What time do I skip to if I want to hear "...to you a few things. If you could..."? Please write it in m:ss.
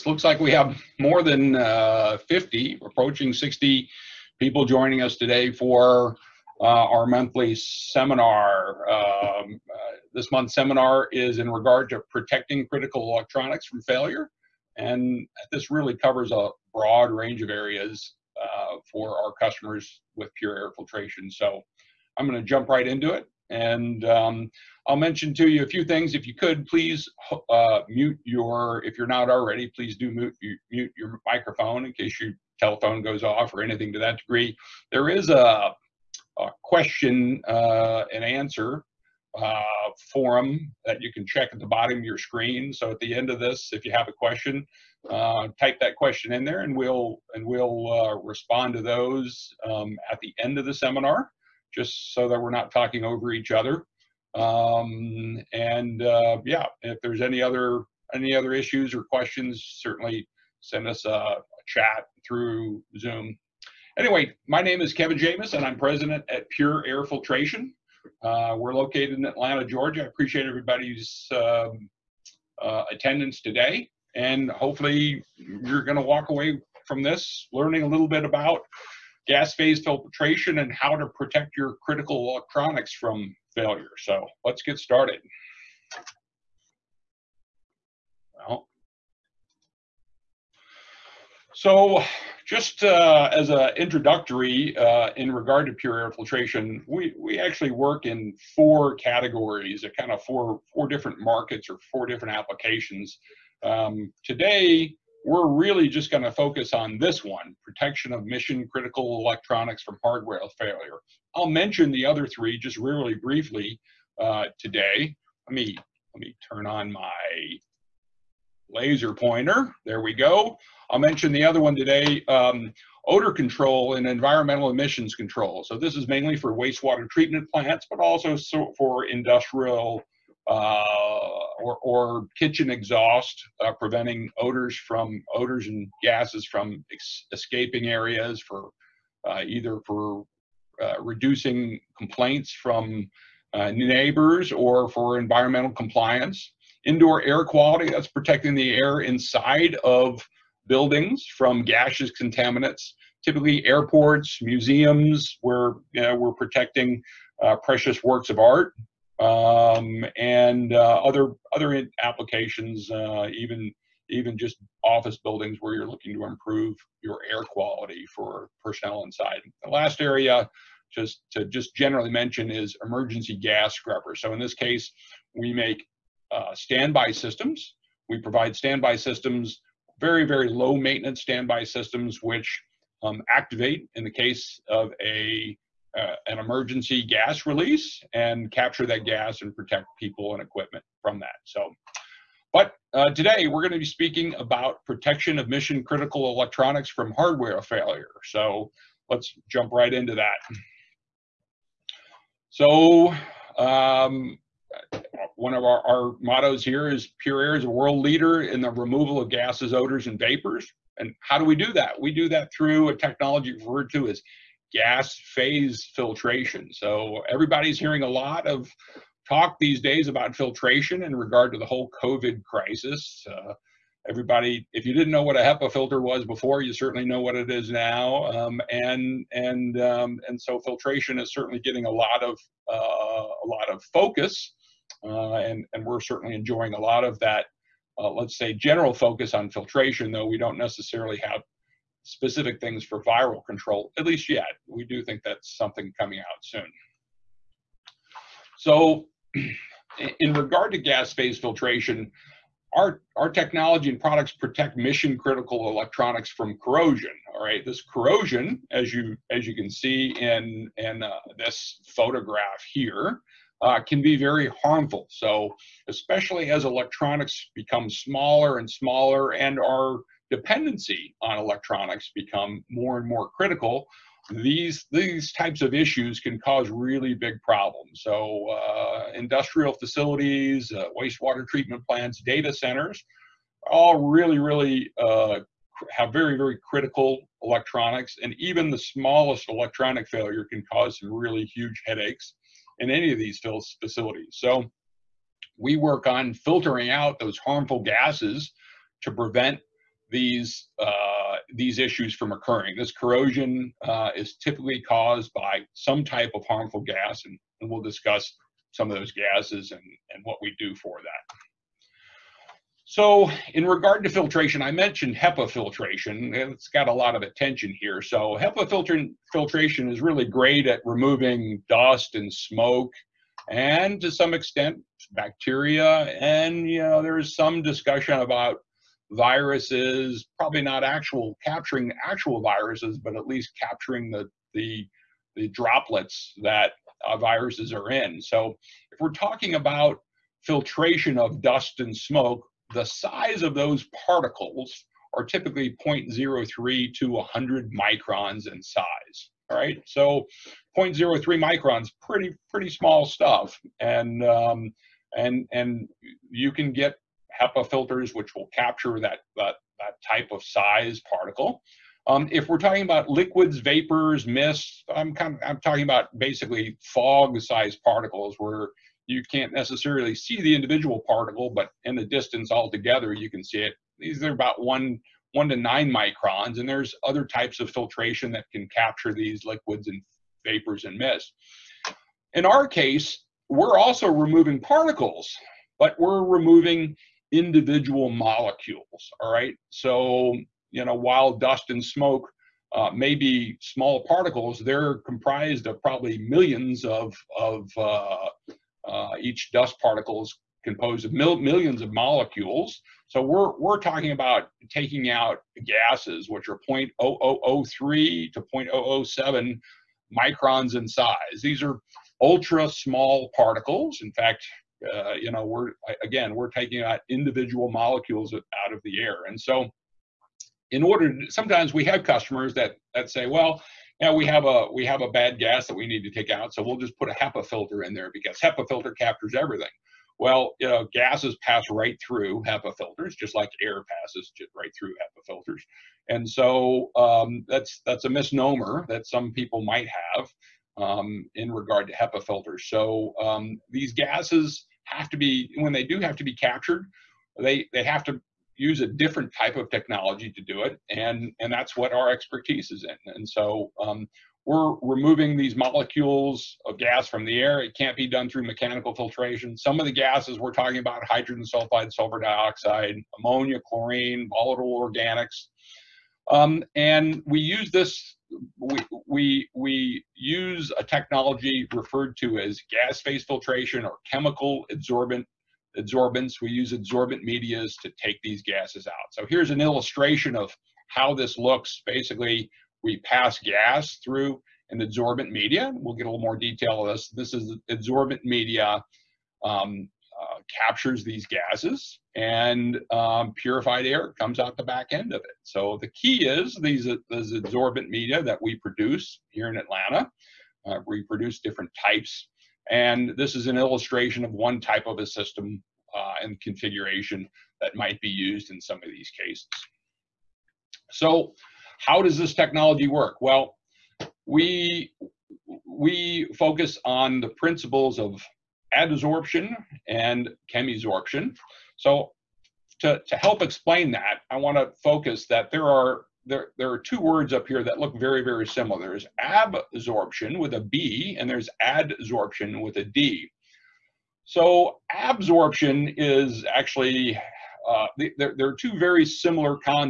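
0:25.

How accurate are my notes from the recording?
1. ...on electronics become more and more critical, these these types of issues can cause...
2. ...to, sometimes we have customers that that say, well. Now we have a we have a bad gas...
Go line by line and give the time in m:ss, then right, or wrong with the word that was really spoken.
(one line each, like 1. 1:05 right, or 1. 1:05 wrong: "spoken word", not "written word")
1. 4:31 right
2. 7:01 right.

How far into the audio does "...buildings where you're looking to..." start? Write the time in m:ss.
2:45.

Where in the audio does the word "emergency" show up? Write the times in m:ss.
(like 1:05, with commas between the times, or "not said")
2:52, 3:06.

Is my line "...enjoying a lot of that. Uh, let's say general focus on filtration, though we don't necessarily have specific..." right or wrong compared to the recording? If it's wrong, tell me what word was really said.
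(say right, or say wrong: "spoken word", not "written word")
right.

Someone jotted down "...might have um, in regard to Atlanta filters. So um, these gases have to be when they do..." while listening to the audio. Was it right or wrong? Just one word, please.
wrong.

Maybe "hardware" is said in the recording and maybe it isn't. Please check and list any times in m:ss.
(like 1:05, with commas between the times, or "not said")
1:50, 3:17.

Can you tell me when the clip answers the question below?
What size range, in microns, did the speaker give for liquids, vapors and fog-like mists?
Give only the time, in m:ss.
6:15.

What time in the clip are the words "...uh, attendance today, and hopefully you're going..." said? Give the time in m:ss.
1:12.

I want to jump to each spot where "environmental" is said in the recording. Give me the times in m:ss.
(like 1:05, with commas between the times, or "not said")
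2:04, 2:25.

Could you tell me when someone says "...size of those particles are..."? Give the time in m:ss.
5:42.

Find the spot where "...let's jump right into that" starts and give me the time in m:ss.
3:19.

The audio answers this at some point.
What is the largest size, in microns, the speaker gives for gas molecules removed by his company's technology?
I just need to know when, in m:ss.
6:48.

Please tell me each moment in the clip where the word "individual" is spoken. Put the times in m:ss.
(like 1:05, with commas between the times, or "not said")
6:10, 6:27, 6:57.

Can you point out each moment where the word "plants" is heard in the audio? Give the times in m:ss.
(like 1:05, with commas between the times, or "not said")
2:07, 4:41.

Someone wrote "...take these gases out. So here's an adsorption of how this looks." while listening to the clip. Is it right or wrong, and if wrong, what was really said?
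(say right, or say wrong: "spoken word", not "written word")
wrong: "illustration", not "adsorption".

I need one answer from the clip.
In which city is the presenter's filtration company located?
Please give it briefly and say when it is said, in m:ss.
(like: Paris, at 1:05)
Atlanta, Georgia, at 1:09.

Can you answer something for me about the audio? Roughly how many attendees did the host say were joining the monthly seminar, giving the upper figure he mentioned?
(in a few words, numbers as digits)
60.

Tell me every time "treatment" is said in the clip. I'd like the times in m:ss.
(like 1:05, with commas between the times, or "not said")
2:07, 4:41.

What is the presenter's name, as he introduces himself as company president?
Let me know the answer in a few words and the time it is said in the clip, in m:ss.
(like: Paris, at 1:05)
Kevin Jamis, at 1:04.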